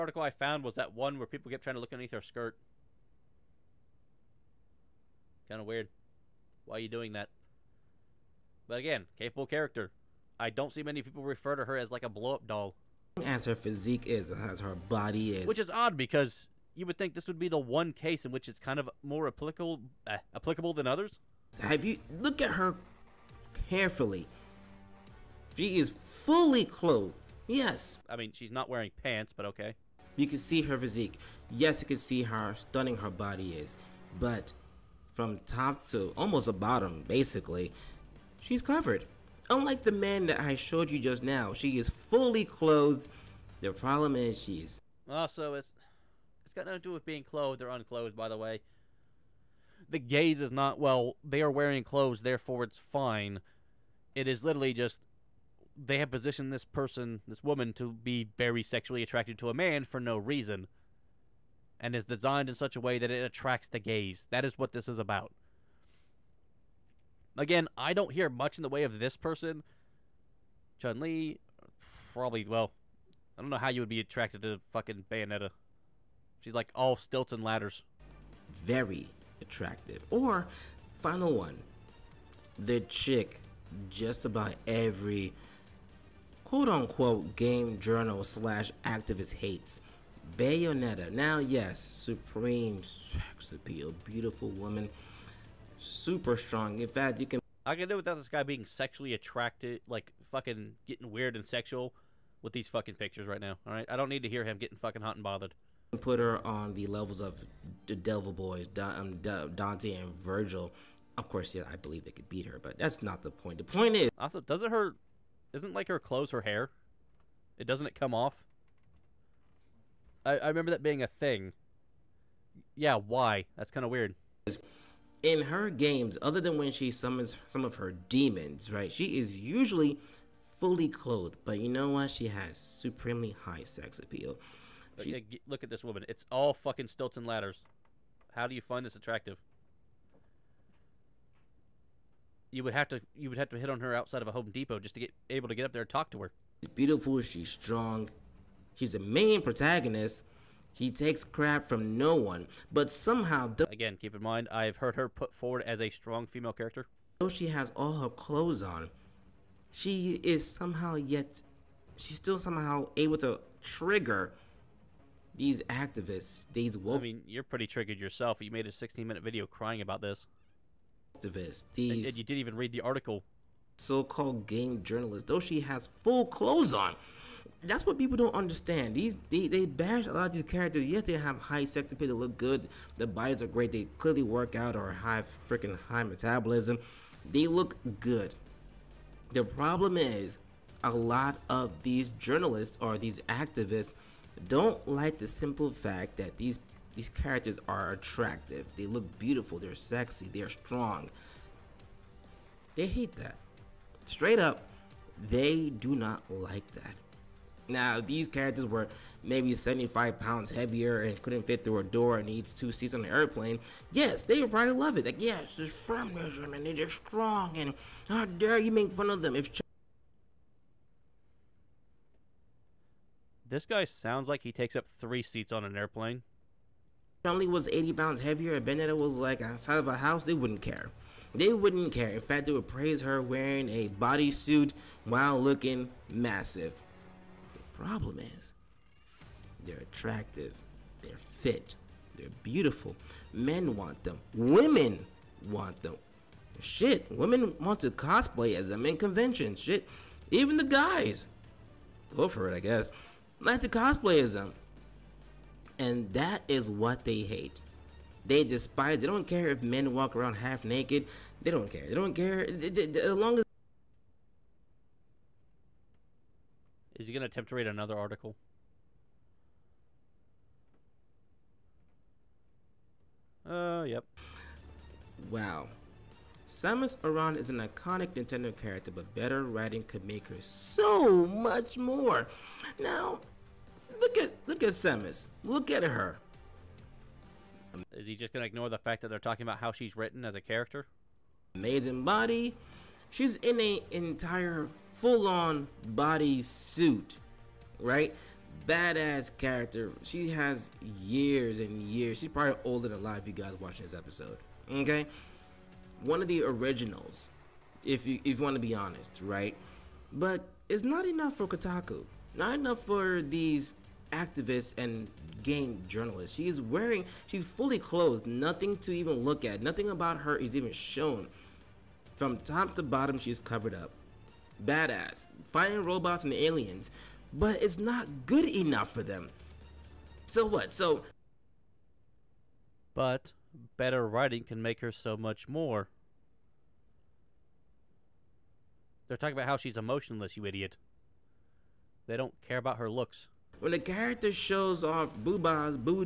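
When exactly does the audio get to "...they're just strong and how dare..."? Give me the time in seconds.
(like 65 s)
216 s.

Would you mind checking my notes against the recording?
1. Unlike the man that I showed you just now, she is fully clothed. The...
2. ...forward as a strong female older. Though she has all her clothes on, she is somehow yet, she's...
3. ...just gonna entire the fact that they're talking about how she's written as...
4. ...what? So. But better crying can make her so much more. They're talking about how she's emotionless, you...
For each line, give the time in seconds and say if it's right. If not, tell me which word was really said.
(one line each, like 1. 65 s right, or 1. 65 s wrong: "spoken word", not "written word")
1. 39 s right
2. 155 s wrong: "character", not "older"
3. 288 s wrong: "ignore", not "entire"
4. 330 s wrong: "writing", not "crying".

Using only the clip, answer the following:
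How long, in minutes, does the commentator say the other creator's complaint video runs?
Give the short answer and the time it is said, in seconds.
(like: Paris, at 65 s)
16 minutes, at 168 s.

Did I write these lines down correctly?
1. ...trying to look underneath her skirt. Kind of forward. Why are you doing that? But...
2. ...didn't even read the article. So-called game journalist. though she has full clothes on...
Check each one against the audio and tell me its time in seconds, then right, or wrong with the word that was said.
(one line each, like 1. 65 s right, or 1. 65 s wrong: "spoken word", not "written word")
1. 1 s wrong: "weird", not "forward"
2. 172 s right.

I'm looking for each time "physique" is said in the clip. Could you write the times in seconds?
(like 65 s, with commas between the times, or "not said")
13 s, 30 s.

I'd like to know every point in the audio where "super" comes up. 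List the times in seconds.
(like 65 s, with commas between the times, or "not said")
95 s.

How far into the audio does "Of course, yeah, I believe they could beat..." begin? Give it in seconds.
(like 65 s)
111 s.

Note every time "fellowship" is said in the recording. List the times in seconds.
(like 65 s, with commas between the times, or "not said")
not said.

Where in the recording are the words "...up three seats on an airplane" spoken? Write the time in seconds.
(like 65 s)
224 s.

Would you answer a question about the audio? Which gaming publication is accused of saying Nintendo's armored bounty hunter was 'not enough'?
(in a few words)
Kotaku.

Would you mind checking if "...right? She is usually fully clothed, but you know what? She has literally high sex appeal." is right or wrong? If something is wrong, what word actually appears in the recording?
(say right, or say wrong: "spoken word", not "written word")
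wrong: "supremely", not "literally".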